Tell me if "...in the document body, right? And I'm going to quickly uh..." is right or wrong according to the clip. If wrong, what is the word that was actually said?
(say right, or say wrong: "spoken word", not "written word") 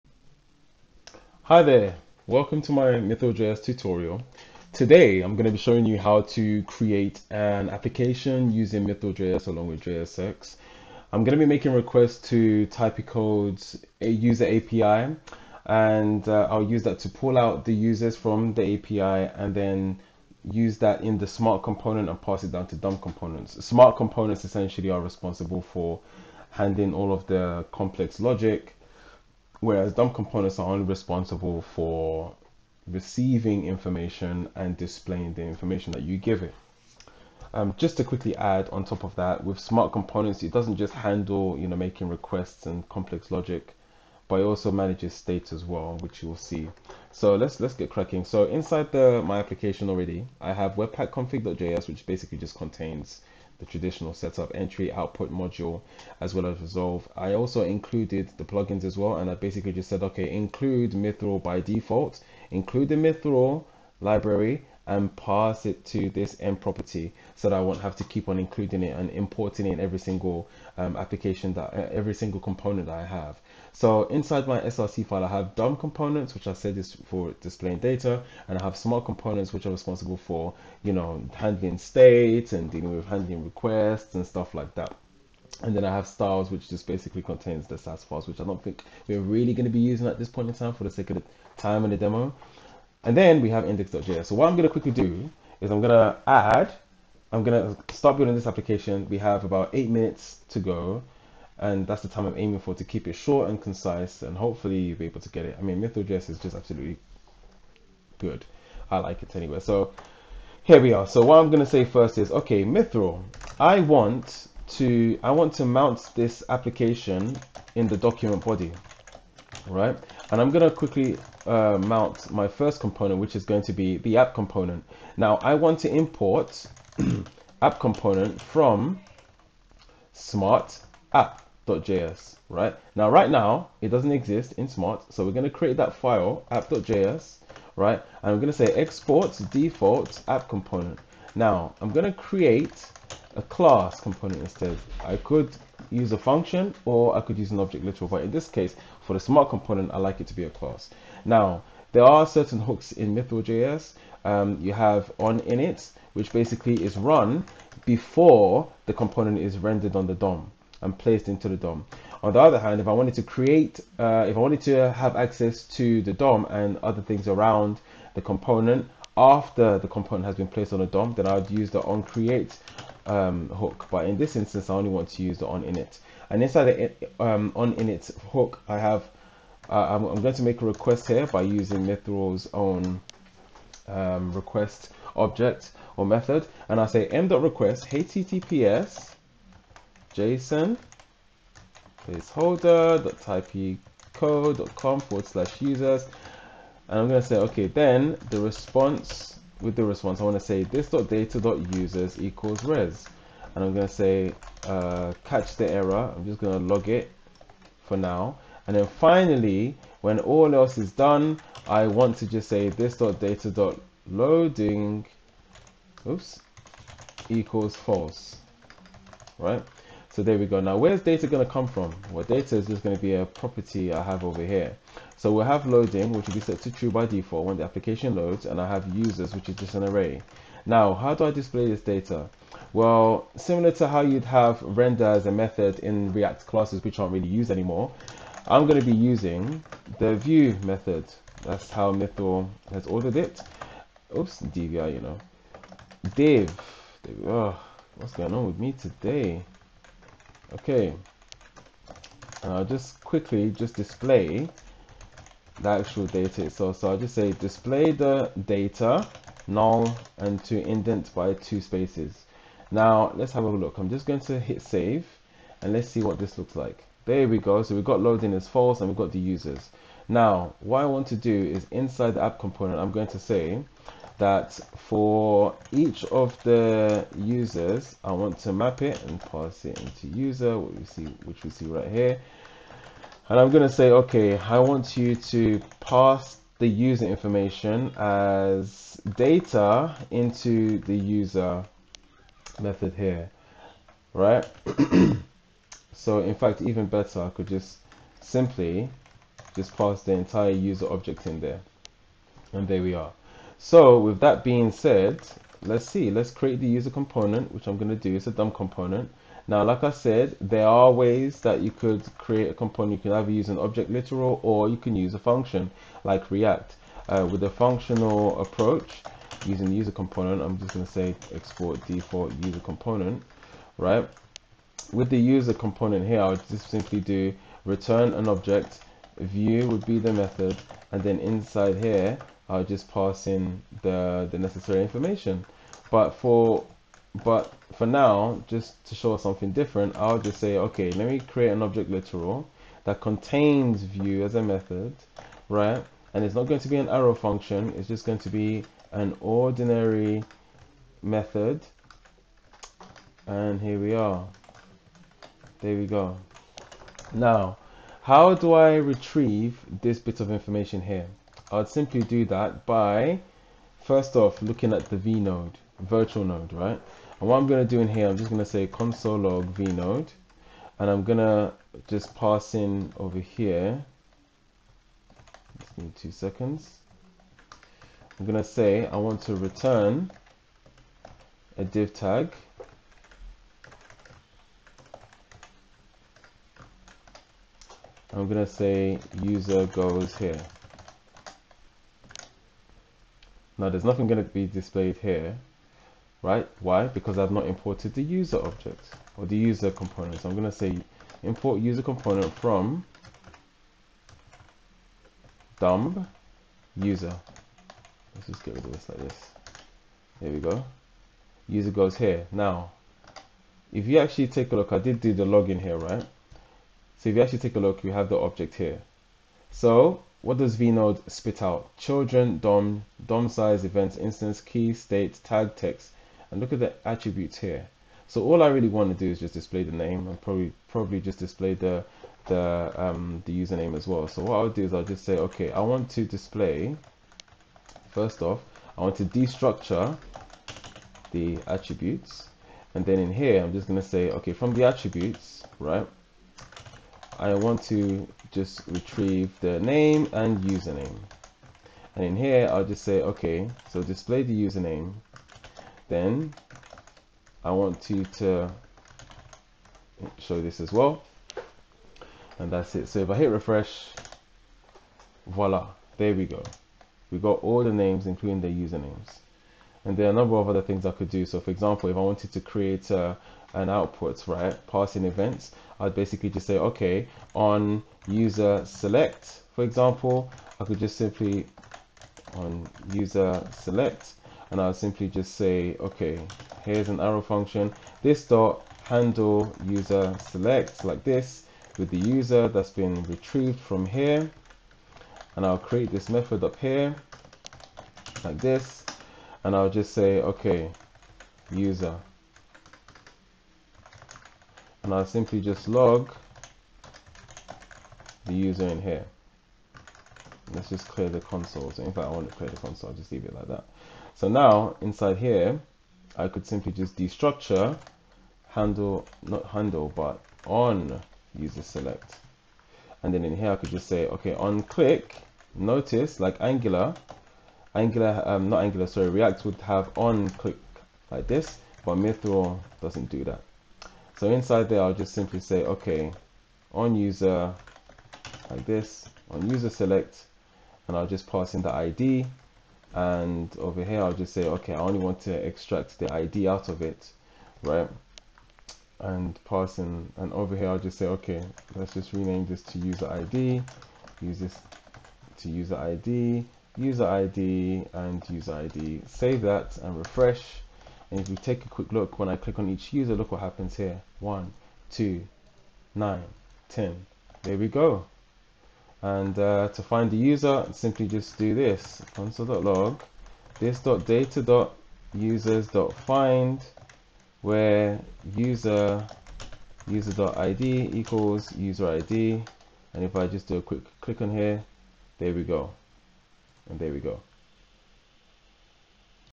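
right.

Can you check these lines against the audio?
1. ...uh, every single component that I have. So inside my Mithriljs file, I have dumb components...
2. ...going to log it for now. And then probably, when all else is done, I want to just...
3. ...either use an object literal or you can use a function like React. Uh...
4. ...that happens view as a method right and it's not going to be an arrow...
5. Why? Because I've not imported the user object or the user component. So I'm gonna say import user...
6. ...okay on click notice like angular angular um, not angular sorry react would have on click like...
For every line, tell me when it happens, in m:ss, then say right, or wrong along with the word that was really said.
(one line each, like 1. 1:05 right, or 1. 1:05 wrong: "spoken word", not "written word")
1. 1:11 wrong: "SRC", not "Mithriljs"
2. 3:26 wrong: "finally", not "probably"
3. 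5:13 right
4. 5:42 wrong: "contains", not "happens"
5. 6:36 right
6. 8:44 right.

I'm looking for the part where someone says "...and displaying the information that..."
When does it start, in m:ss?
0:34.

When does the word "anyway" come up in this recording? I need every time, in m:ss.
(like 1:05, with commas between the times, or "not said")
1:49.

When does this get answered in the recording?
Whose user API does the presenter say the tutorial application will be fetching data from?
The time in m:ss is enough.
0:12.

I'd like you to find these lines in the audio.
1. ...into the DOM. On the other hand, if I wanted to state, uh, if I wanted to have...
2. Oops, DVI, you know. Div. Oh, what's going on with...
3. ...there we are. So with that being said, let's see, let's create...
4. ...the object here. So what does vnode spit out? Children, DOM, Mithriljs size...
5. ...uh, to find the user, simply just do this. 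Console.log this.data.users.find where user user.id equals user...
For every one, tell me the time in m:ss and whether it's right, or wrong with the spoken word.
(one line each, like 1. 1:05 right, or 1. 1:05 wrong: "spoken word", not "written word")
1. 2:41 wrong: "create", not "state"
2. 4:04 right
3. 5:02 right
4. 6:58 wrong: "DOM", not "Mithriljs"
5. 9:29 right.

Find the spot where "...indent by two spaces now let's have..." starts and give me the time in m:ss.
4:20.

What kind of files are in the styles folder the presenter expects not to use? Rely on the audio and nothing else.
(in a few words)
Sass files.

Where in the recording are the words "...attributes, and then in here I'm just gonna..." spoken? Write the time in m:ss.
7:21.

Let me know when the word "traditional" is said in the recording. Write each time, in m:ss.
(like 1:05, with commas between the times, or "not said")
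0:53.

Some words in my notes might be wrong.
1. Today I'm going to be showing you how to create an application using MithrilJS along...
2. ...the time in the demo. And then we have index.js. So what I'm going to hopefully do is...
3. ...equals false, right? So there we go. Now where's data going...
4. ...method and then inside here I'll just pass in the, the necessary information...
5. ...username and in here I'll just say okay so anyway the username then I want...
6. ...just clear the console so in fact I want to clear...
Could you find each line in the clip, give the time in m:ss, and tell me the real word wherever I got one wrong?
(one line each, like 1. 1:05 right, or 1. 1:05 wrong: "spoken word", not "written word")
1. 0:04 right
2. 1:31 wrong: "quickly", not "hopefully"
3. 3:37 right
4. 5:30 right
5. 7:30 wrong: "display", not "anyway"
6. 8:30 right.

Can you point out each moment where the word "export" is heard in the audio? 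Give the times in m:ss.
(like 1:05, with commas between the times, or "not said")
2:18, 5:21.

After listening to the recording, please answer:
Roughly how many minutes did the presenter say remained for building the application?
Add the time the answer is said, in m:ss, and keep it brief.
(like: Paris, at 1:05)
8, at 1:39.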